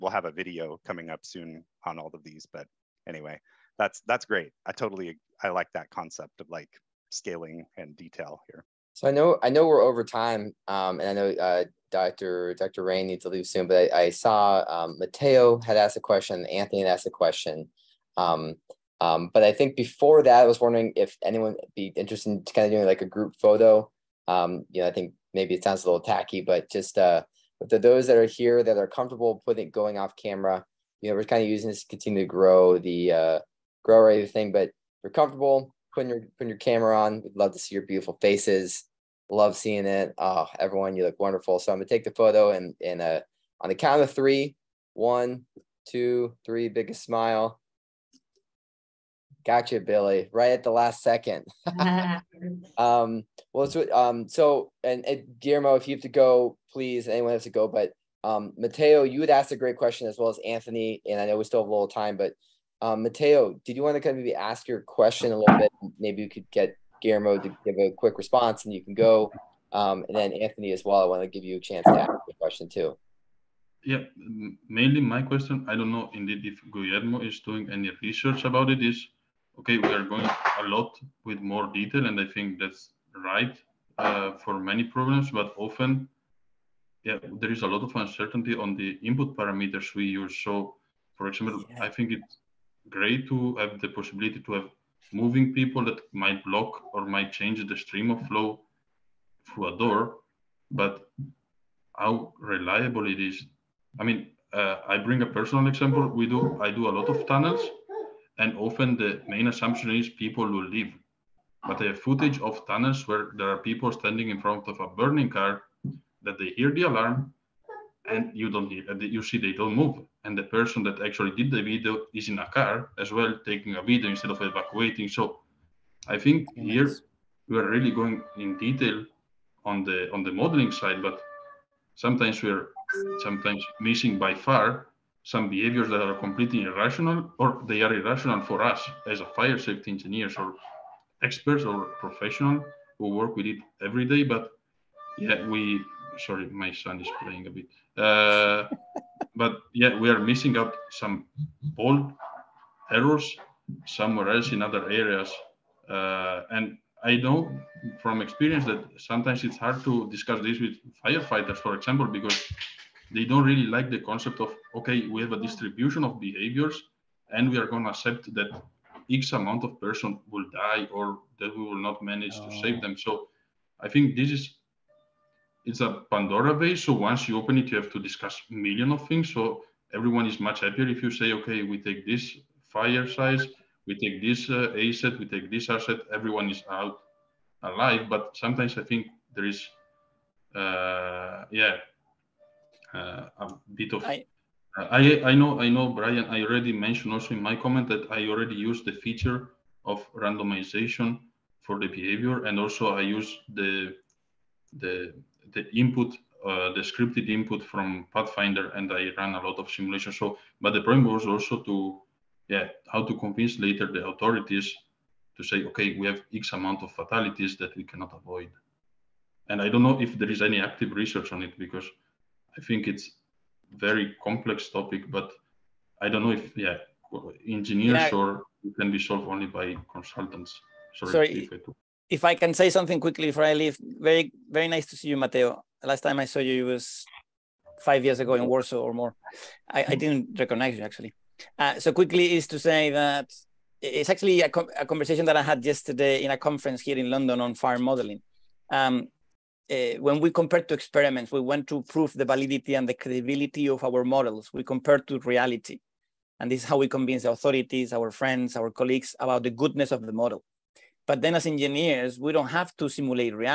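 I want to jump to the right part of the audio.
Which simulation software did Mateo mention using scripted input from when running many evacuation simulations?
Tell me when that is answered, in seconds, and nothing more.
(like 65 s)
208 s.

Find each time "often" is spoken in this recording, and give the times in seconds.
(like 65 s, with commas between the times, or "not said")
85 s, 108 s.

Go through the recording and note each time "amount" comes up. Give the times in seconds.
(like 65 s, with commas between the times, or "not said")
169 s, 216 s.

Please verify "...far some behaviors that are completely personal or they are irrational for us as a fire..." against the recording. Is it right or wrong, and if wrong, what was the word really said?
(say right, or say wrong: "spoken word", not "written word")
wrong: "irrational", not "personal".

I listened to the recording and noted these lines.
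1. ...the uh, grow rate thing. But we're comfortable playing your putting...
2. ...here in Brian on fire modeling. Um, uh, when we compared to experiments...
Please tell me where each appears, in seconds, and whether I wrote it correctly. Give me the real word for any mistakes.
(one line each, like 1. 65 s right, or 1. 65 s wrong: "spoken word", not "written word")
1. 32 s wrong: "putting", not "playing"
2. 246 s wrong: "London", not "Brian".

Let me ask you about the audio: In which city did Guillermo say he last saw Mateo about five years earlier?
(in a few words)
Warsaw.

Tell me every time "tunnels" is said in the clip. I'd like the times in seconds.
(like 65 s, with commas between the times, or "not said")
107 s, 112 s.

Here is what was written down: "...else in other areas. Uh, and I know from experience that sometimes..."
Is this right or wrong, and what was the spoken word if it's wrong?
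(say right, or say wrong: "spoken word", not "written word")
right.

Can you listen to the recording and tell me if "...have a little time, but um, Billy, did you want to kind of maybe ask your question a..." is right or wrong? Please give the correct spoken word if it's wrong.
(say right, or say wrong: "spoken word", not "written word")
wrong: "Mateo", not "Billy".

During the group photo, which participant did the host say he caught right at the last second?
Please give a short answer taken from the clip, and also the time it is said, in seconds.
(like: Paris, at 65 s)
Billy, at 49 s.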